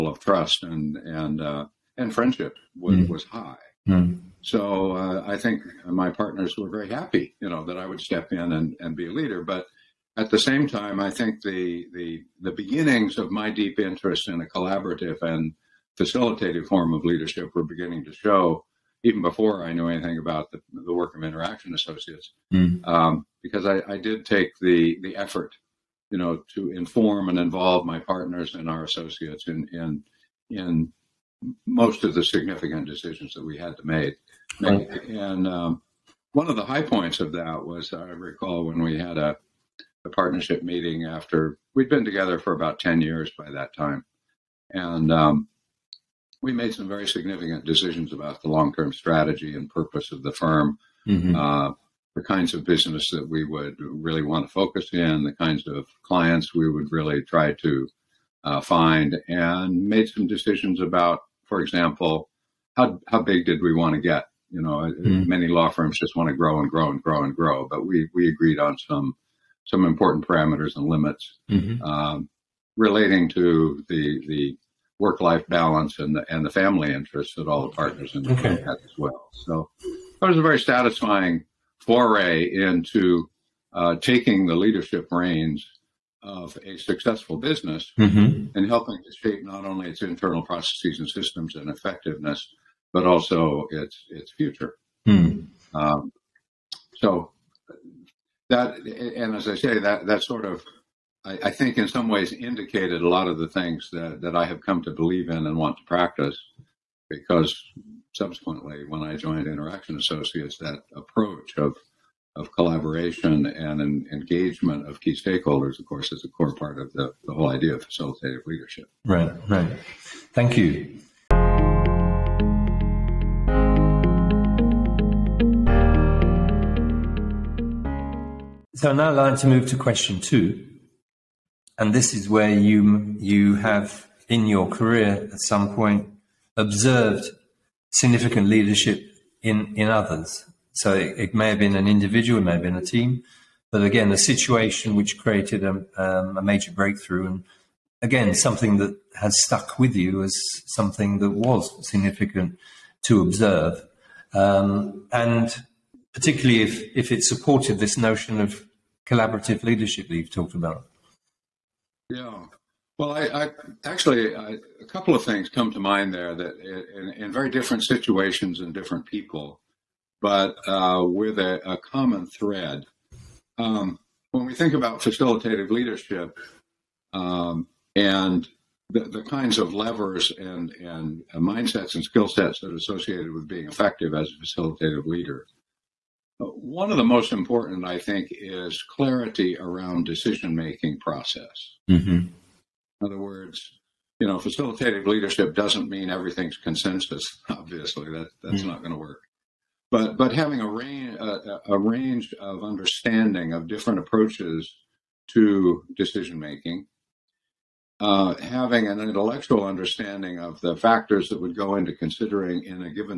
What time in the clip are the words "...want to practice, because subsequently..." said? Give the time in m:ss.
1:45.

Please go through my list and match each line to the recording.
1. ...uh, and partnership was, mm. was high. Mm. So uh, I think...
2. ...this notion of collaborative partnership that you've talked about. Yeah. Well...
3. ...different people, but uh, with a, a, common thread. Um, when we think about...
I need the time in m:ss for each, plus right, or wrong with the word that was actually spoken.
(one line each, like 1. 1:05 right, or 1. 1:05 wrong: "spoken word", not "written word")
1. 0:01 wrong: "friendship", not "partnership"
2. 2:37 wrong: "leadership", not "partnership"
3. 2:48 right.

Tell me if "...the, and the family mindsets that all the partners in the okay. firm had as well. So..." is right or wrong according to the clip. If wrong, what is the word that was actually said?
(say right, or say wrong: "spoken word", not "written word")
wrong: "interests", not "mindsets".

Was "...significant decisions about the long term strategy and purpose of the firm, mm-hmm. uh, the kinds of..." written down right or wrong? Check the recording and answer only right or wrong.
right.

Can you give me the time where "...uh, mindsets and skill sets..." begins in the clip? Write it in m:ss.
3:01.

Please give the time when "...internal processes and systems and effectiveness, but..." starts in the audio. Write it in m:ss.
1:30.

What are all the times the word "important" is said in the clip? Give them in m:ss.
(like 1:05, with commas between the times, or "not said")
1:09, 3:07.